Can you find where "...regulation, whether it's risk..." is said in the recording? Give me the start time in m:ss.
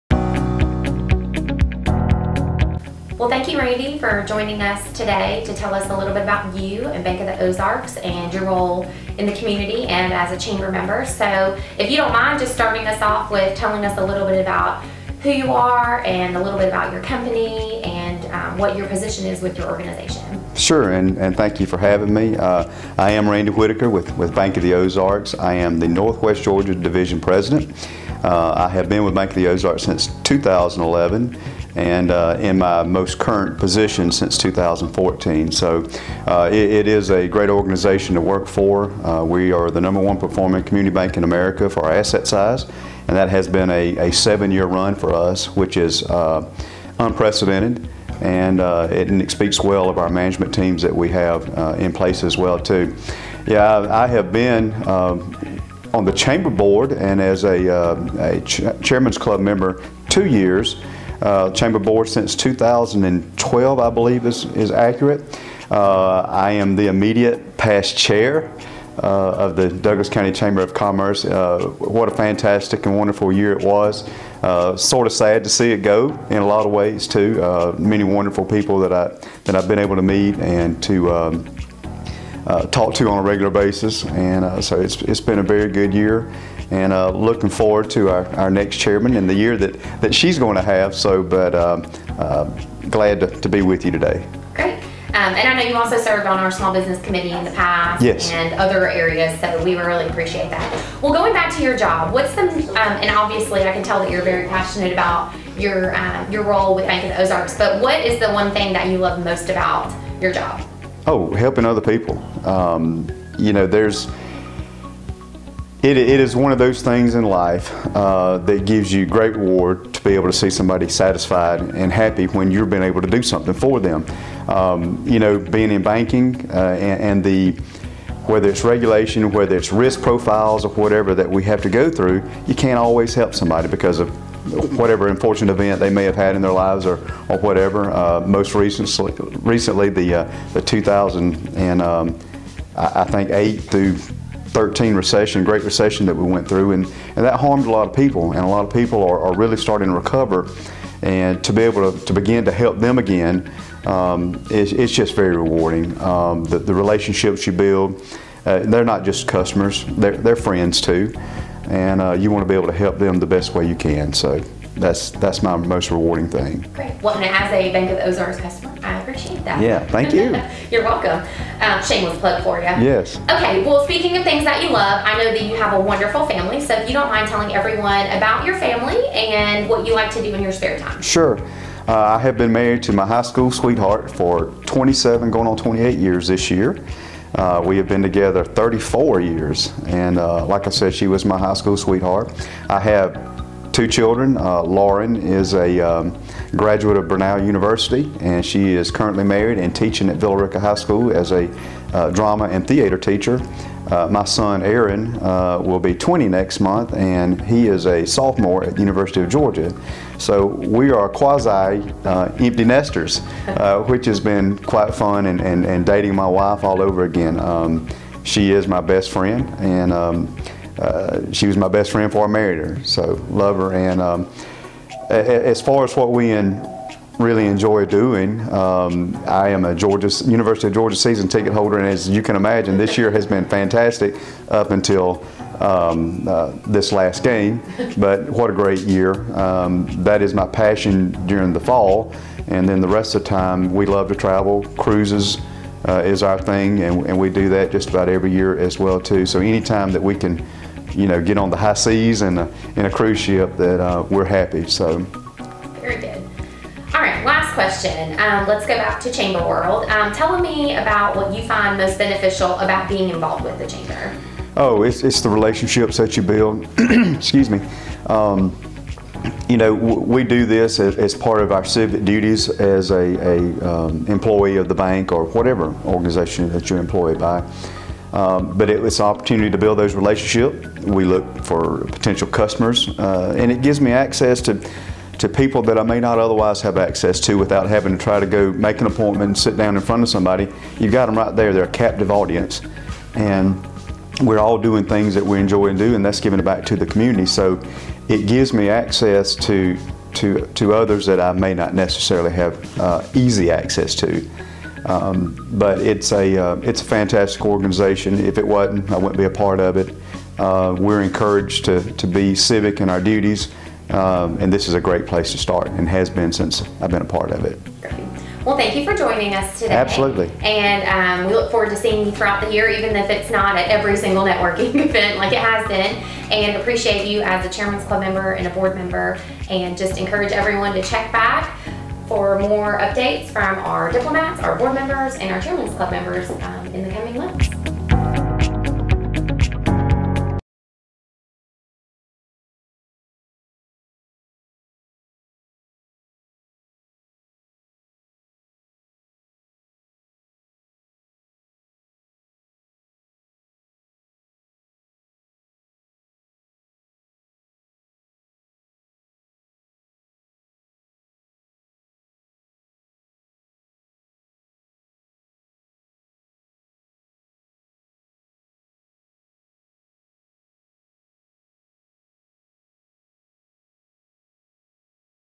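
2:08.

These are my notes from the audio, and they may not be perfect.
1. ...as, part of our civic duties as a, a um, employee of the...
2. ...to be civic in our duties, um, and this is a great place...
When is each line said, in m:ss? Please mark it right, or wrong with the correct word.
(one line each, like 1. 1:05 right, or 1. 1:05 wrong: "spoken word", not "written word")
1. 4:30 right
2. 5:11 right.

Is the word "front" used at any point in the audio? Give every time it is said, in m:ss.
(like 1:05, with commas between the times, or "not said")
4:49.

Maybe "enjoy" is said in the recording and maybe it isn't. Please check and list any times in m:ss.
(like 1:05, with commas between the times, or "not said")
3:47, 4:55.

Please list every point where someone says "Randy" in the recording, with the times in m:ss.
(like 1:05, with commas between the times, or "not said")
0:03, 0:23.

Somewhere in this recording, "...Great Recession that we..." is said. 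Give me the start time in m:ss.
2:25.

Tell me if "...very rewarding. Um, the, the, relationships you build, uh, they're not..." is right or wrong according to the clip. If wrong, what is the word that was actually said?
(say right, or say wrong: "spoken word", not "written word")
right.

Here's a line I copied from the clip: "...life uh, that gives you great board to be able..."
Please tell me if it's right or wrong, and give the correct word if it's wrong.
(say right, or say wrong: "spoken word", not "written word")
wrong: "reward", not "board".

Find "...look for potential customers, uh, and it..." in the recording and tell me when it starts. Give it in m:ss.
4:41.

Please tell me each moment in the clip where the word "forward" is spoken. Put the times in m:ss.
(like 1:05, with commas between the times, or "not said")
1:27, 5:21.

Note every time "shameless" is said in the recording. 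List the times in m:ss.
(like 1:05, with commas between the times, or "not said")
2:51.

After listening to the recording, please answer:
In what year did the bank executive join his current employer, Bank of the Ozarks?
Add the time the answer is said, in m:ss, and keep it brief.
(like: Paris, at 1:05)
2011, at 0:30.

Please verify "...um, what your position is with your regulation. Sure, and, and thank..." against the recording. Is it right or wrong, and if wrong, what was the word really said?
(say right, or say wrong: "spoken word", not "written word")
wrong: "organization", not "regulation".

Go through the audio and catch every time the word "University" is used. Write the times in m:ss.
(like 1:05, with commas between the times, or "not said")
3:17, 3:28, 3:50.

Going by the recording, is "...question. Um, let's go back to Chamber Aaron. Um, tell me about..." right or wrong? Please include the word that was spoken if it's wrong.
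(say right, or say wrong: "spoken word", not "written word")
wrong: "World", not "Aaron".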